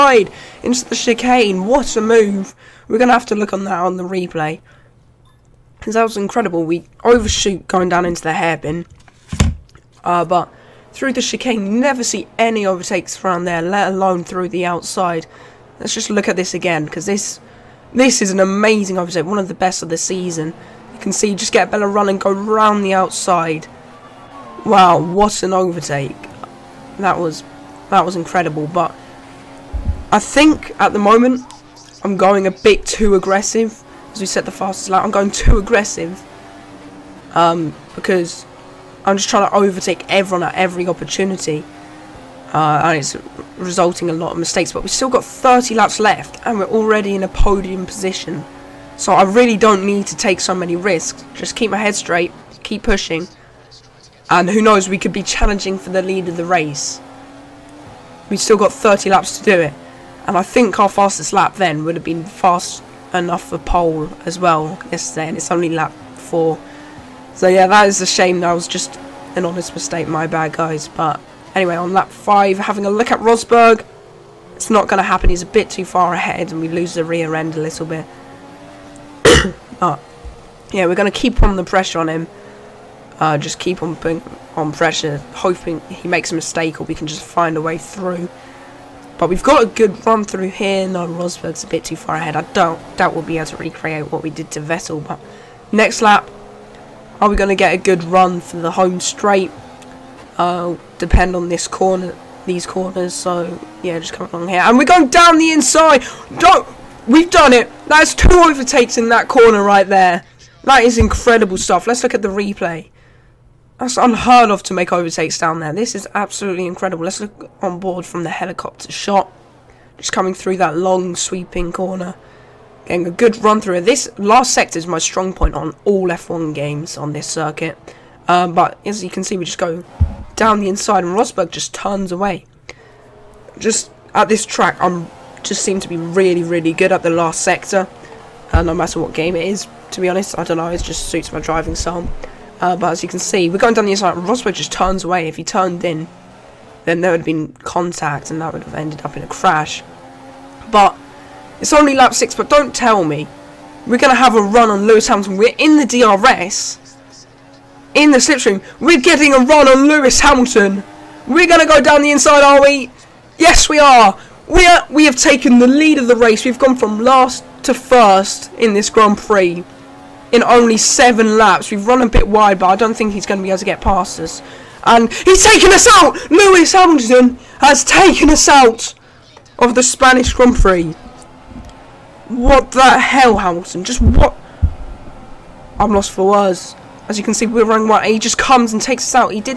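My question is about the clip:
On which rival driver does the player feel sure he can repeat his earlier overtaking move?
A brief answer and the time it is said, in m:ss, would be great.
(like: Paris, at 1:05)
Vettel, at 1:34.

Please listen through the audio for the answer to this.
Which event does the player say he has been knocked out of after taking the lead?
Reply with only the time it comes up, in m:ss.
2:59.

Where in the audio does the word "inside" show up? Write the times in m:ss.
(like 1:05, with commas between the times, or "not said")
1:45, 2:10, 2:23, 2:42.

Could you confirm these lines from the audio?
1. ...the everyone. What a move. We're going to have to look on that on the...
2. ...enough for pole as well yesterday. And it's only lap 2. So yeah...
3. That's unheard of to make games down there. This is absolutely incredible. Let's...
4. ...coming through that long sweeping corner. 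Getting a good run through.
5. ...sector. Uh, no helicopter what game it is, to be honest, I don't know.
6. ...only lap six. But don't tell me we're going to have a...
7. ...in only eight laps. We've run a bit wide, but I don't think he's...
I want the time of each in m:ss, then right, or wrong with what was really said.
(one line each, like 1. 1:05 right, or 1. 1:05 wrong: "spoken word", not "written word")
1. 0:00 wrong: "chicane", not "everyone"
2. 1:03 wrong: "4", not "2"
3. 1:53 wrong: "overtakes", not "games"
4. 2:00 right
5. 2:17 wrong: "matter", not "helicopter"
6. 2:31 right
7. 2:50 wrong: "seven", not "eight".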